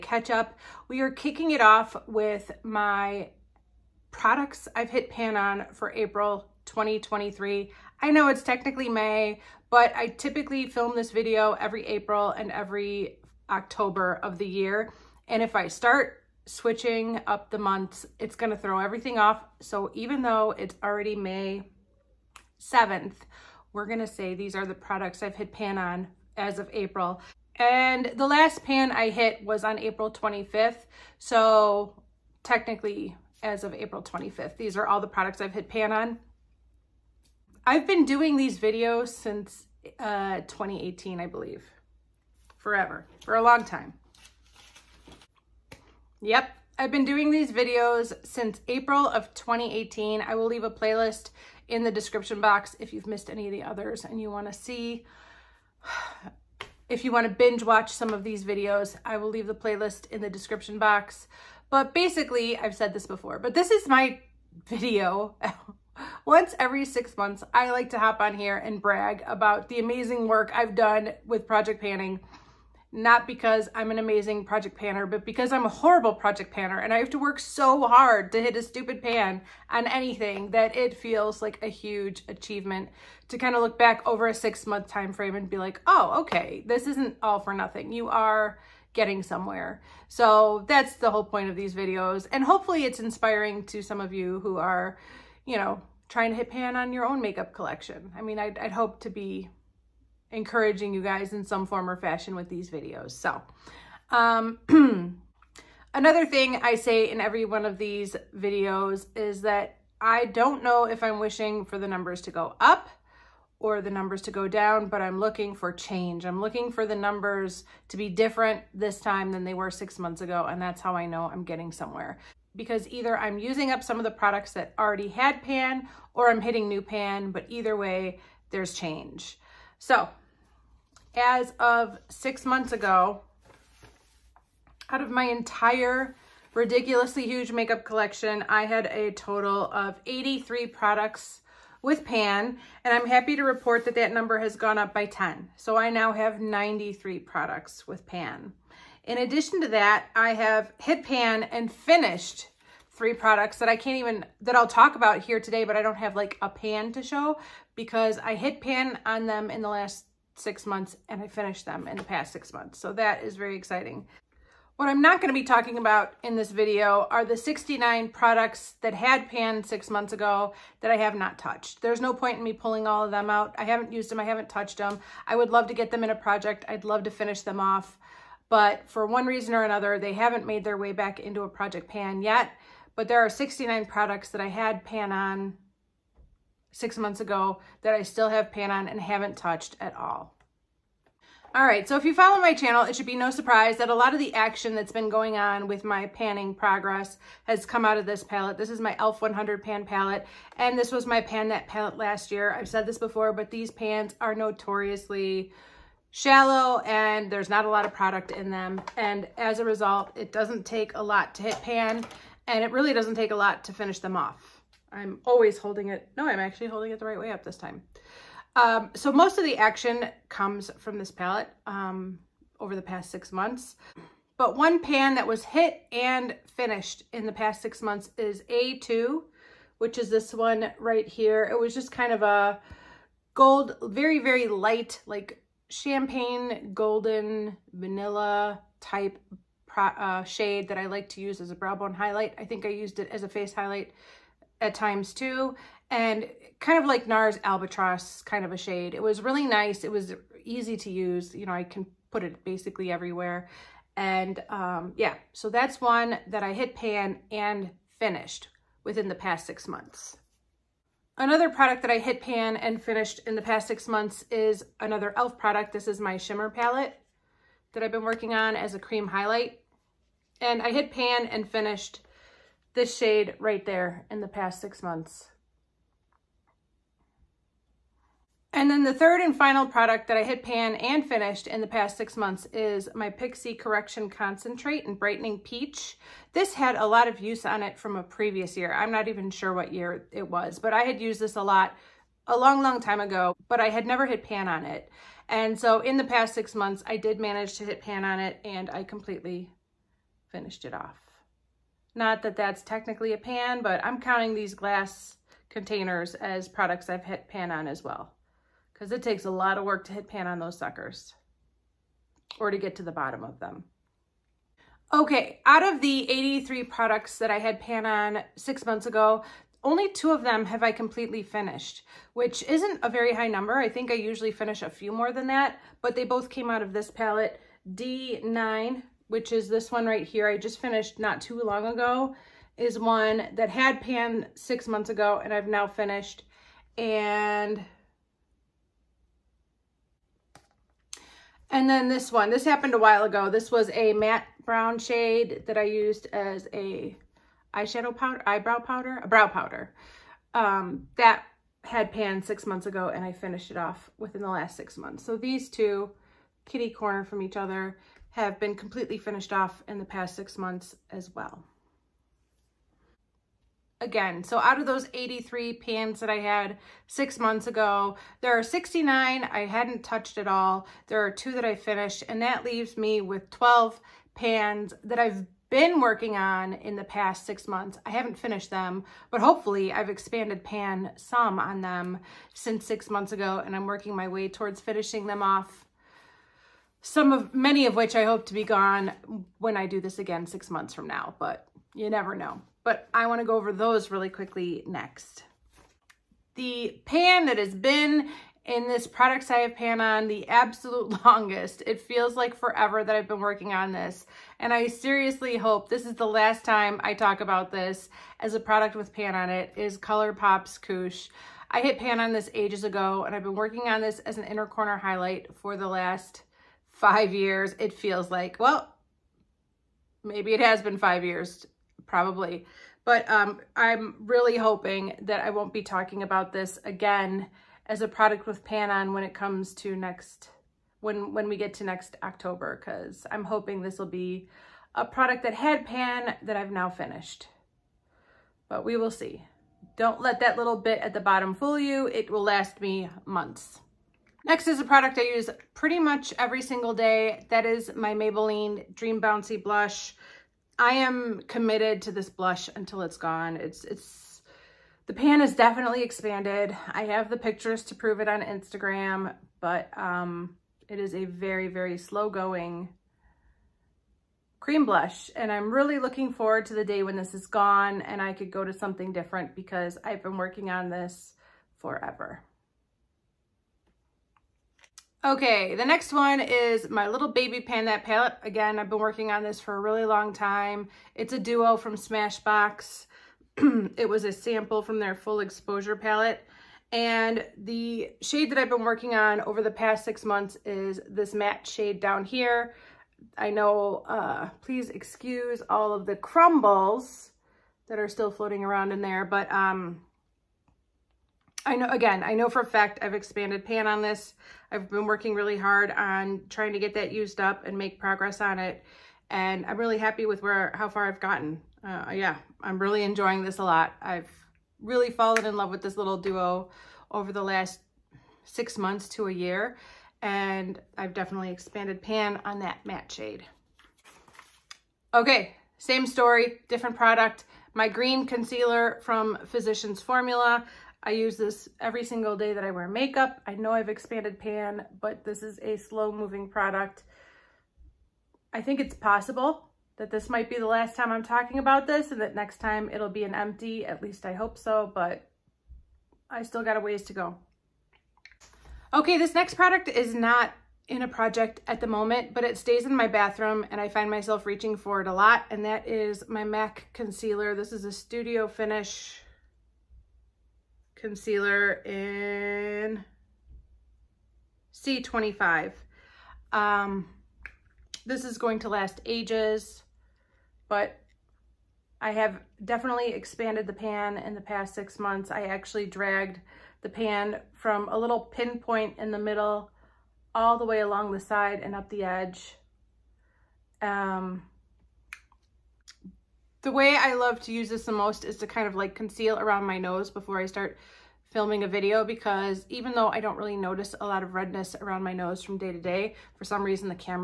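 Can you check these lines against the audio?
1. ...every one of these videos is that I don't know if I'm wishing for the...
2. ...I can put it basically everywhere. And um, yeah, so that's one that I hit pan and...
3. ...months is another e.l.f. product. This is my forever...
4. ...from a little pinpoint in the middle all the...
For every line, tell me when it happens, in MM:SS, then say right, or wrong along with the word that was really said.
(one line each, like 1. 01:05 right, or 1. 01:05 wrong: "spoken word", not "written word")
1. 01:47 right
2. 04:11 right
3. 04:23 wrong: "shimmer", not "forever"
4. 09:37 right.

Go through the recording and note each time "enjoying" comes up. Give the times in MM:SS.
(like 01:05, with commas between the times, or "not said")
08:32.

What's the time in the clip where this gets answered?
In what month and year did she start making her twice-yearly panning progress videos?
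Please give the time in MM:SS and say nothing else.
00:48.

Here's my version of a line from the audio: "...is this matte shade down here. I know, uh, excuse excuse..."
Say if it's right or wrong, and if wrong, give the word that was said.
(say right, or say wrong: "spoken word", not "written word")
wrong: "please", not "excuse".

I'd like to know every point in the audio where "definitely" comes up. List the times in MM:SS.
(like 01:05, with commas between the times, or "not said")
07:35, 08:40, 09:32.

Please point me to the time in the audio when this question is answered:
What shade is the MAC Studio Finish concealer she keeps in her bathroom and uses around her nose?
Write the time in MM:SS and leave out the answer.
09:24.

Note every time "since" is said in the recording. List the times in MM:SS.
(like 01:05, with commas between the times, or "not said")
00:39, 00:48, 06:22.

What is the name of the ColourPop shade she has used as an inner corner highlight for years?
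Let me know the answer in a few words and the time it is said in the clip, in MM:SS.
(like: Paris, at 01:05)
Koosh, at 06:50.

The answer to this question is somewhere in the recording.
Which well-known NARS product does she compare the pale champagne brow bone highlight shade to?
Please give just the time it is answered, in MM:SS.
04:07.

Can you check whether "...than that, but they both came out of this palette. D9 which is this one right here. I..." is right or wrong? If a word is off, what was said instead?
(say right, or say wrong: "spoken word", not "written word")
right.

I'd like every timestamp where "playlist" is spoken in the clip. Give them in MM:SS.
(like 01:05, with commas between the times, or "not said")
00:50, 00:59.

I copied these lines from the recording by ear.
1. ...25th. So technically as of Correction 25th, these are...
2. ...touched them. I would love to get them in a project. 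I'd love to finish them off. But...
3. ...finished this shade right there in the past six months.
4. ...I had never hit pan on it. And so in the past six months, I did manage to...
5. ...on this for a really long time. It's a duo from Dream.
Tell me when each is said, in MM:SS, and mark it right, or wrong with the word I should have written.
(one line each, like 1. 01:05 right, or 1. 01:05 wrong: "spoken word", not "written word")
1. 00:30 wrong: "April", not "Correction"
2. 02:54 right
3. 04:31 right
4. 04:53 right
5. 07:59 wrong: "Smashbox", not "Dream".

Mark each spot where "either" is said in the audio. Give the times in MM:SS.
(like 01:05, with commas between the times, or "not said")
02:02, 02:07.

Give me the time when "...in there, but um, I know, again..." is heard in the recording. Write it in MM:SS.
08:18.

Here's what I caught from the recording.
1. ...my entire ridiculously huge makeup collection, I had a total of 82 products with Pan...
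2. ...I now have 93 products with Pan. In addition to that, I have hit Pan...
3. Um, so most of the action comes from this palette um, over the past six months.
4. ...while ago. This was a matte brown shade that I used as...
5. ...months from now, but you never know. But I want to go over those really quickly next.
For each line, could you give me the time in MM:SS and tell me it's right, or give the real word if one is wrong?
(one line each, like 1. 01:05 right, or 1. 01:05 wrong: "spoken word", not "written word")
1. 02:15 wrong: "83", not "82"
2. 02:25 right
3. 03:38 right
4. 05:42 right
5. 06:30 right.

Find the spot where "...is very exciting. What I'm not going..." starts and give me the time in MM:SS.
02:43.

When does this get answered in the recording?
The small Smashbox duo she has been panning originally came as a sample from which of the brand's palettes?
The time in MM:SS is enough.
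08:04.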